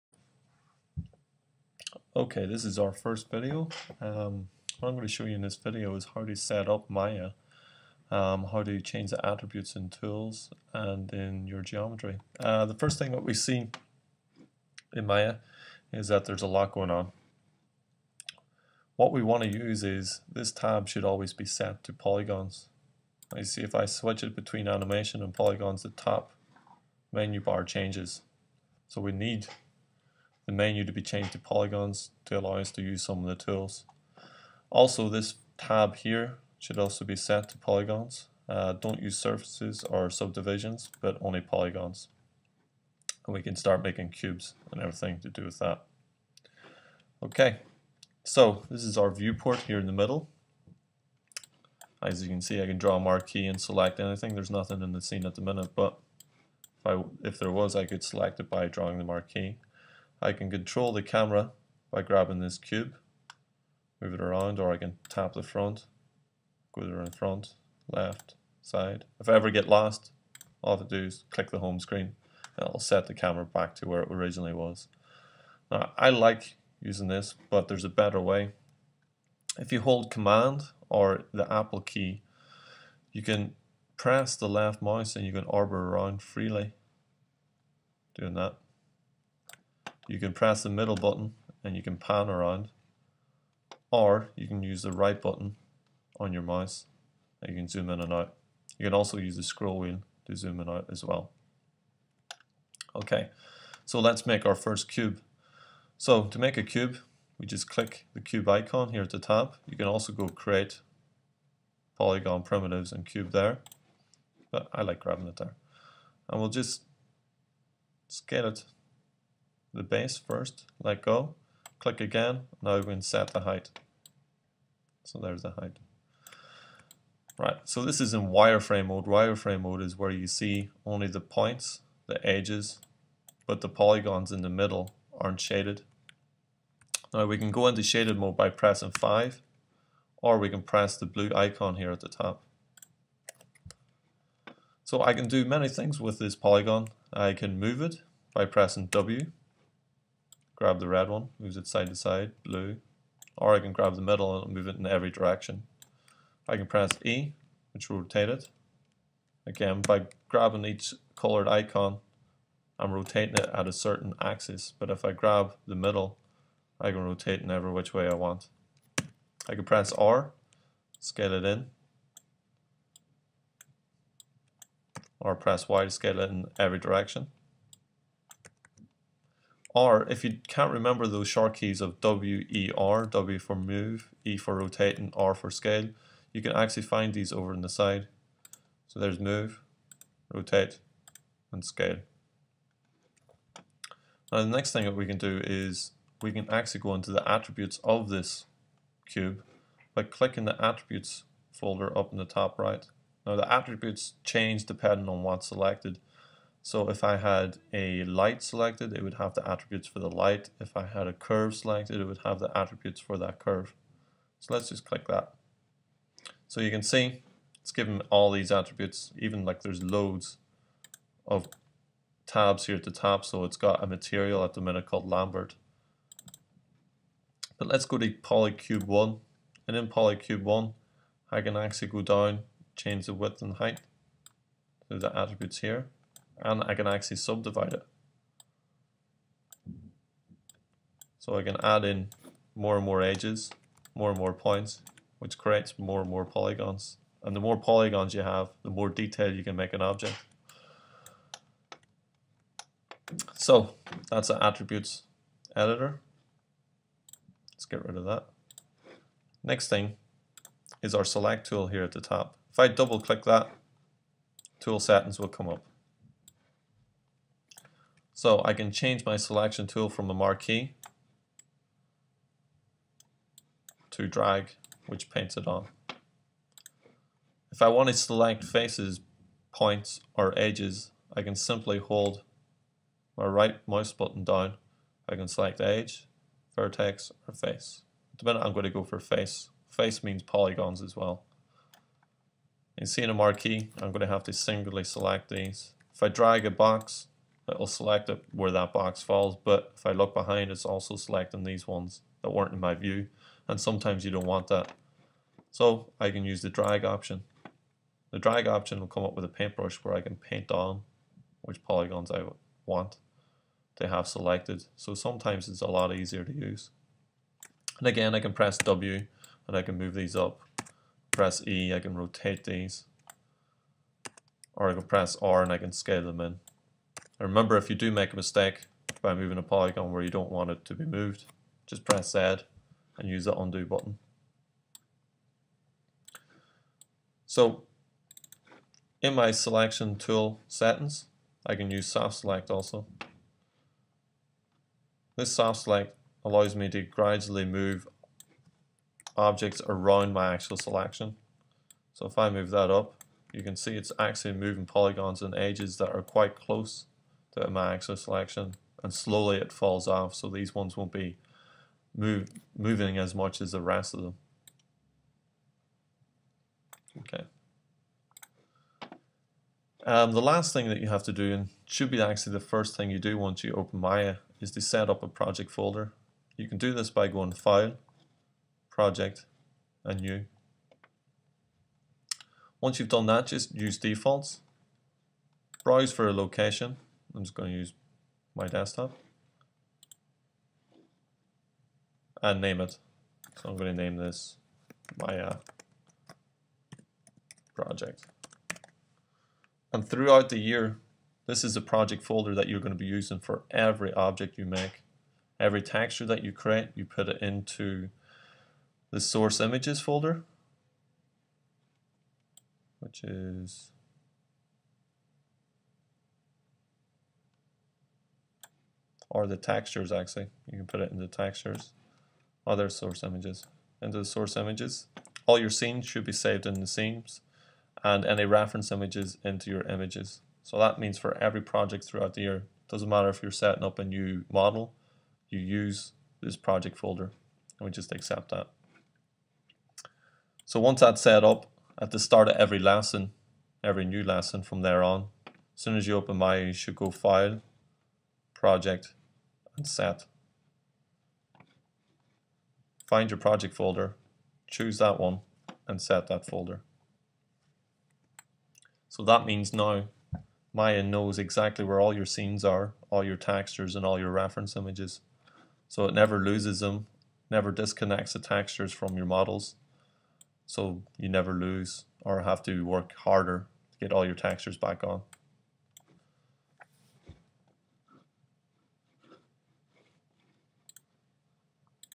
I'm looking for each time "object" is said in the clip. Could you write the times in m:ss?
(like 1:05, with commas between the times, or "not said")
4:09, 5:49, 6:43.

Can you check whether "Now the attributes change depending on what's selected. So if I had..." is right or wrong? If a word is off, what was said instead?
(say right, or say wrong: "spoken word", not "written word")
right.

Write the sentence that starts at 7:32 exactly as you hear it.
Find your project folder, choose that one, and set that folder.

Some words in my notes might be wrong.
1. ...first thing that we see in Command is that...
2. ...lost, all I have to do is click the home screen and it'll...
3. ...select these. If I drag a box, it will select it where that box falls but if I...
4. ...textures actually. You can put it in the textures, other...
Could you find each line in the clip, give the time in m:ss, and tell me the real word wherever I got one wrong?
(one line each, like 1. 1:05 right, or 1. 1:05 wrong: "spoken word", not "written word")
1. 0:12 wrong: "Maya", not "Command"
2. 1:09 right
3. 4:54 right
4. 6:59 right.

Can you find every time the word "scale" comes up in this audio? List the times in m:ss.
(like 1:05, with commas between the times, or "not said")
1:58, 2:50, 2:55, 3:05, 3:11, 5:25.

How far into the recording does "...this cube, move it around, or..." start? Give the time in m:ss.
1:02.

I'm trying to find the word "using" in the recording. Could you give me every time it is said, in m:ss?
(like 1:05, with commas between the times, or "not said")
1:16, 6:42.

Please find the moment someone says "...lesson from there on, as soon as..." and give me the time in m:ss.
7:24.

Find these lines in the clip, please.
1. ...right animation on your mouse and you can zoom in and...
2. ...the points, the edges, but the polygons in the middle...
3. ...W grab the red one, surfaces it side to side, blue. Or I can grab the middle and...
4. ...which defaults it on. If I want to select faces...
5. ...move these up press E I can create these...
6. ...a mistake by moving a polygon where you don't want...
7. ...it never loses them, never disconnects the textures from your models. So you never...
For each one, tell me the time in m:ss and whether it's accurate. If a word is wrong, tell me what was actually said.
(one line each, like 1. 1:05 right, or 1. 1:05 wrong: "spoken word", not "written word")
1. 1:34 wrong: "button", not "animation"
2. 2:11 right
3. 2:28 wrong: "moves", not "surfaces"
4. 4:34 wrong: "paints", not "defaults"
5. 5:19 wrong: "rotate", not "create"
6. 5:28 right
7. 7:45 right.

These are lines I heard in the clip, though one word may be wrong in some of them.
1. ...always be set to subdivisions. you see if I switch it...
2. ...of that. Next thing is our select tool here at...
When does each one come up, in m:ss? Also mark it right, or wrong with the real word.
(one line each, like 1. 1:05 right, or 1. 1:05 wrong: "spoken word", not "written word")
1. 0:21 wrong: "polygons", not "subdivisions"
2. 4:17 right.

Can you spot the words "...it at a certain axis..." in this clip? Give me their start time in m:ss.
2:43.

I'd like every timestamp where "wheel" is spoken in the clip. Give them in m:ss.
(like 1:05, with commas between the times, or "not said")
1:39.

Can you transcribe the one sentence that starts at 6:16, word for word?
You can do this by going File, Project, and New.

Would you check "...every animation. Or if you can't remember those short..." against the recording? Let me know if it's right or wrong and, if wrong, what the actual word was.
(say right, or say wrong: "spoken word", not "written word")
wrong: "direction", not "animation".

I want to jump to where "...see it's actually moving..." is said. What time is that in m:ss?
5:53.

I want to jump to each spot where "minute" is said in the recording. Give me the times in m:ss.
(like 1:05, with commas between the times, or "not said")
0:55, 3:44, 4:48.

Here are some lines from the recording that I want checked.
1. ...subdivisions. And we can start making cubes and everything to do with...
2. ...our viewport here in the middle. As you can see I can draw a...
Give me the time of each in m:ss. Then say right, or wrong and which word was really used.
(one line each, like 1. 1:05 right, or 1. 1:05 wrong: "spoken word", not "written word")
1. 0:41 wrong: "polygons", not "subdivisions"
2. 0:48 right.